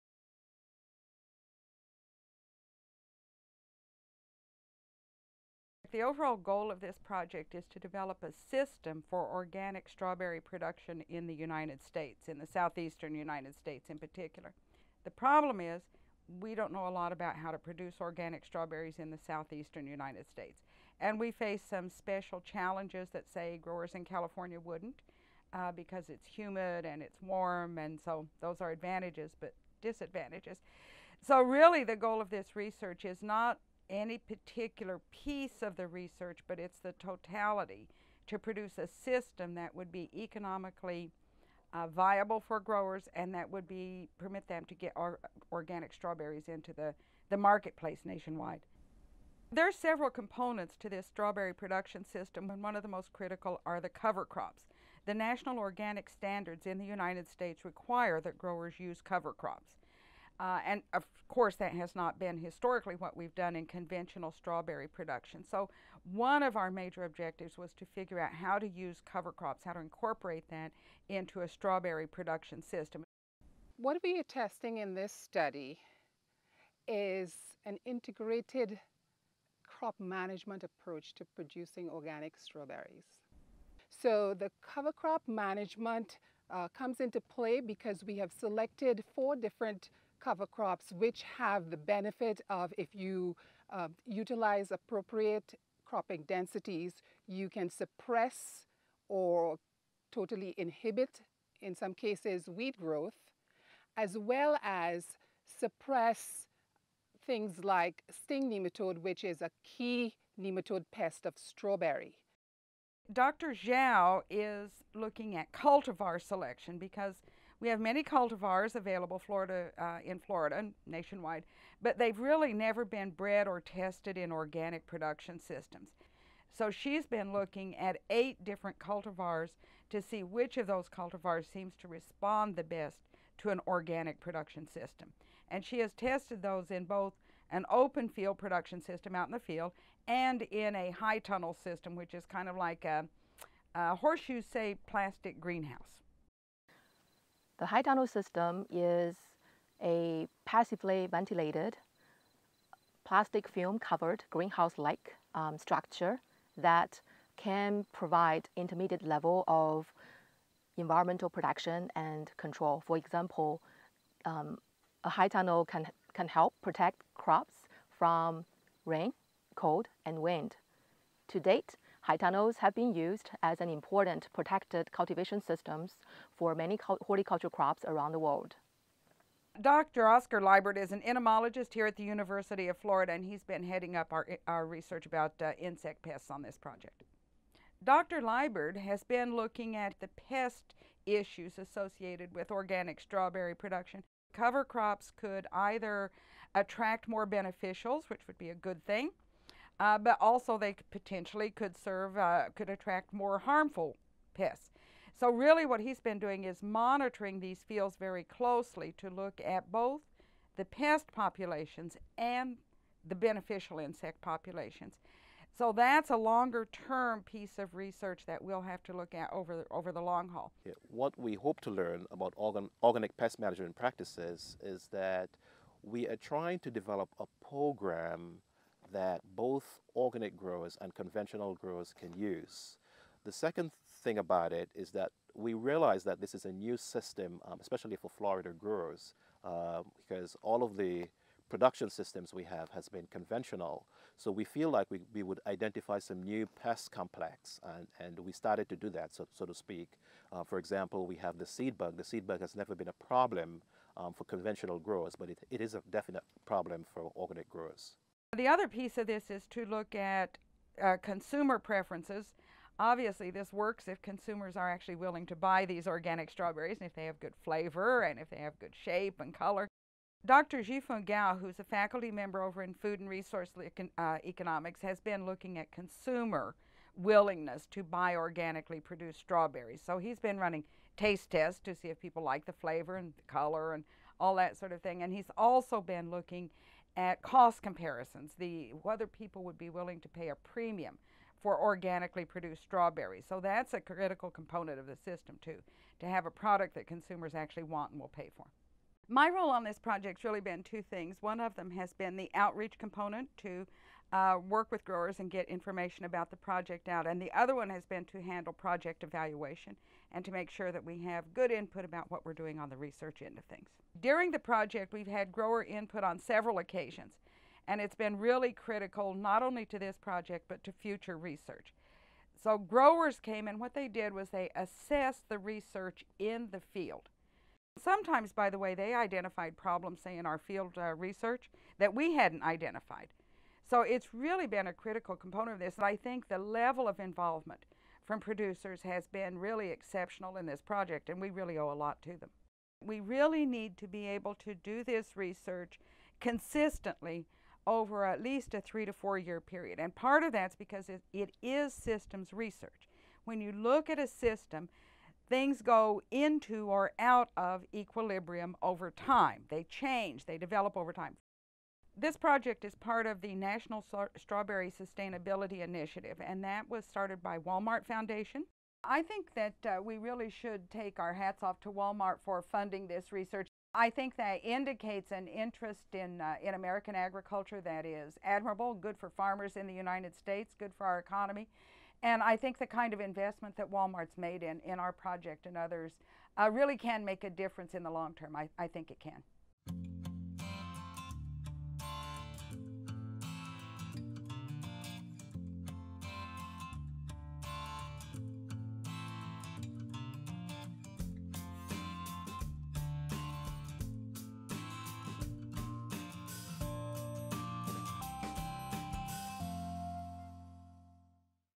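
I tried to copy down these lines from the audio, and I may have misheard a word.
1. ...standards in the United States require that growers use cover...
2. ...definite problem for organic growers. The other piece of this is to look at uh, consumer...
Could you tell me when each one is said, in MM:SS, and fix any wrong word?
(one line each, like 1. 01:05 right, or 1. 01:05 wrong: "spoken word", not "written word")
1. 00:56 right
2. 04:15 right.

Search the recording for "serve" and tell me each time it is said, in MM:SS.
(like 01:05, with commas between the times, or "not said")
03:21.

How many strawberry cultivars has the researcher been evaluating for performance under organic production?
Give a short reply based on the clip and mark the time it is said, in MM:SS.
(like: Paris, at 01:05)
8, at 02:08.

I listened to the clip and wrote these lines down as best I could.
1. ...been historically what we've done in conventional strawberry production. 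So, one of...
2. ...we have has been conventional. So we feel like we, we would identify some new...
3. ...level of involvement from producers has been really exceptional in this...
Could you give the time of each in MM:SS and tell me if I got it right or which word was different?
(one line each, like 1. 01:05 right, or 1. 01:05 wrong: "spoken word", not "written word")
1. 01:02 right
2. 04:02 right
3. 05:36 right.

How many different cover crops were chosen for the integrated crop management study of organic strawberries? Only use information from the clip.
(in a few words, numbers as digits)
4.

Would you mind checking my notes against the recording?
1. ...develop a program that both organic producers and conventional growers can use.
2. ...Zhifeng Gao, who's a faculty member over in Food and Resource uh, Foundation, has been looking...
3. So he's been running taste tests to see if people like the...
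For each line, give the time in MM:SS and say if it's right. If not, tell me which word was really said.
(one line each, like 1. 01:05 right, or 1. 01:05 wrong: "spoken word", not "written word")
1. 03:46 wrong: "growers", not "producers"
2. 04:30 wrong: "Economics", not "Foundation"
3. 04:39 right.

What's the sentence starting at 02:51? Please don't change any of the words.
To date, high tunnels have been used as an important protected cultivation systems for many horticultural crops around the world.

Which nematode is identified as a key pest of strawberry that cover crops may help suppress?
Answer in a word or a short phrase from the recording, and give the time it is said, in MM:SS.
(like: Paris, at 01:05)
sting nematode, at 01:48.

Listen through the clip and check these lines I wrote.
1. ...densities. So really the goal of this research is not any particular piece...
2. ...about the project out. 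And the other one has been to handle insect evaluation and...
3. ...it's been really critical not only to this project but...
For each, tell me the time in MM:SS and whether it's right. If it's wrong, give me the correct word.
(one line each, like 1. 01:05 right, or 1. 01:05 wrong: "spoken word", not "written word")
1. 00:29 wrong: "disadvantages", not "densities"
2. 05:06 wrong: "project", not "insect"
3. 05:17 right.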